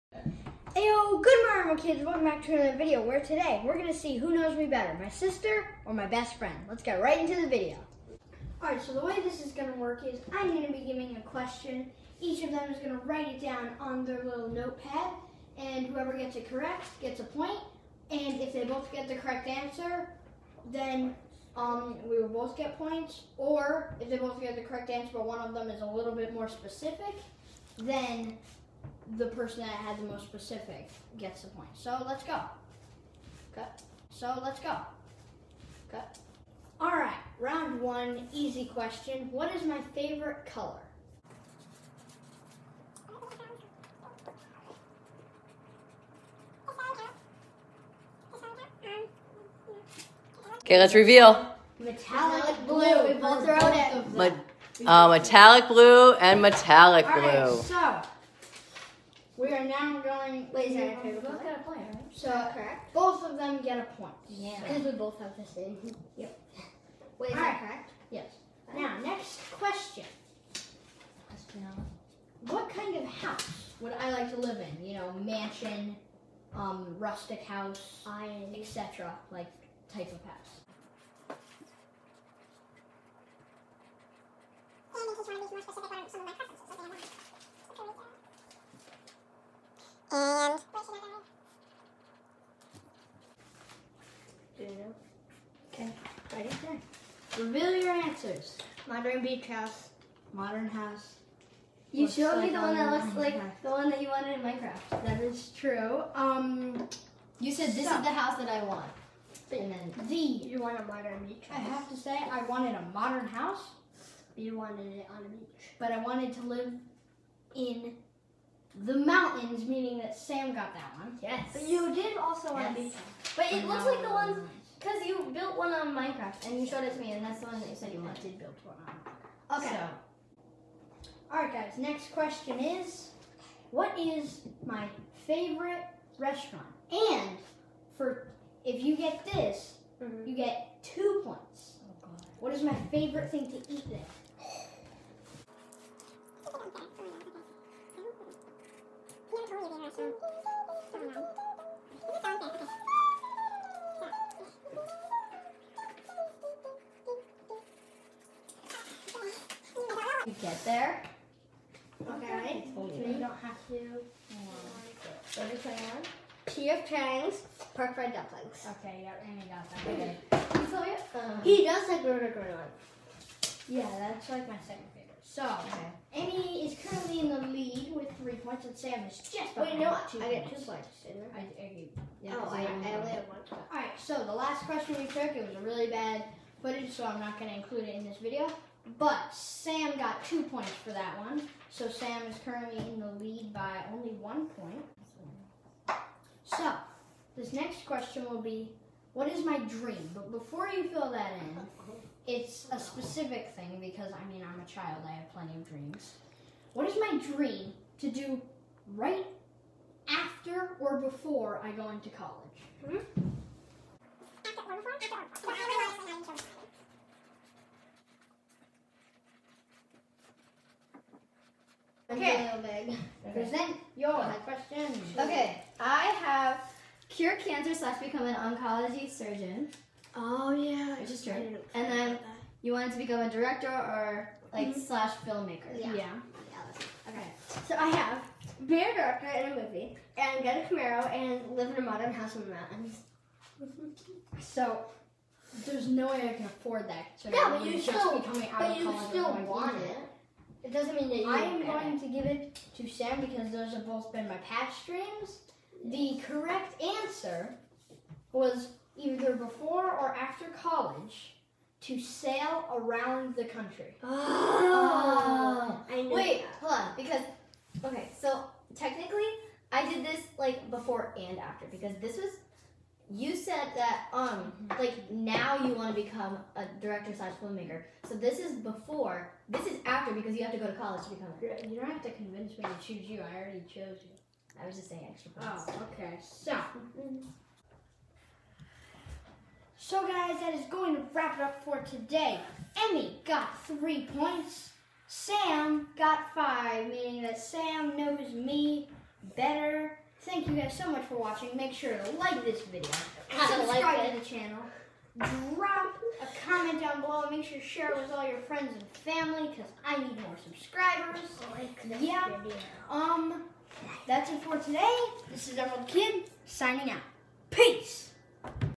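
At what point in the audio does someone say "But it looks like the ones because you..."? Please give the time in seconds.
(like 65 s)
123 s.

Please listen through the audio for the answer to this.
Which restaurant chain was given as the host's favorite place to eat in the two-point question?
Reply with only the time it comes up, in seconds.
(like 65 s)
166 s.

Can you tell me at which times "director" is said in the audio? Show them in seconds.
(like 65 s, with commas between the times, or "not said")
233 s, 238 s, 276 s.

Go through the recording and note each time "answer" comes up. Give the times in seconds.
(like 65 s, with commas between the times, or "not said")
19 s, 24 s, 97 s, 256 s.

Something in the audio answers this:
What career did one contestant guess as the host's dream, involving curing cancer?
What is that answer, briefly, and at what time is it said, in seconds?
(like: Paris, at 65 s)
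Oncology surgeon, at 228 s.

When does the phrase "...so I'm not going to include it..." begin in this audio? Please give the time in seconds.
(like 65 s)
186 s.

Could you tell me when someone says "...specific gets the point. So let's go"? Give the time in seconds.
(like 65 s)
30 s.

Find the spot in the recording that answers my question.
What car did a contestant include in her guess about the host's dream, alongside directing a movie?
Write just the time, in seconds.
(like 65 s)
240 s.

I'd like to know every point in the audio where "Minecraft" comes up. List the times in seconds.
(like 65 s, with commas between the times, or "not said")
104 s, 125 s.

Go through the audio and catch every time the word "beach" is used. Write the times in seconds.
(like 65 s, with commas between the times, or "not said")
99 s, 111 s, 115 s, 122 s.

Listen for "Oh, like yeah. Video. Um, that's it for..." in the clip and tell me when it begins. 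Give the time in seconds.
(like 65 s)
311 s.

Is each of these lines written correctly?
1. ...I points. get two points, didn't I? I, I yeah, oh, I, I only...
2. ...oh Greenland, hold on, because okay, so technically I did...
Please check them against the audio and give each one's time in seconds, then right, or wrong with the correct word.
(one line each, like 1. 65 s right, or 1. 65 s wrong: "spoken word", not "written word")
1. 180 s right
2. 265 s wrong: "Wait", not "Greenland".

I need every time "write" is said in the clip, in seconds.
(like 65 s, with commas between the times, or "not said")
13 s.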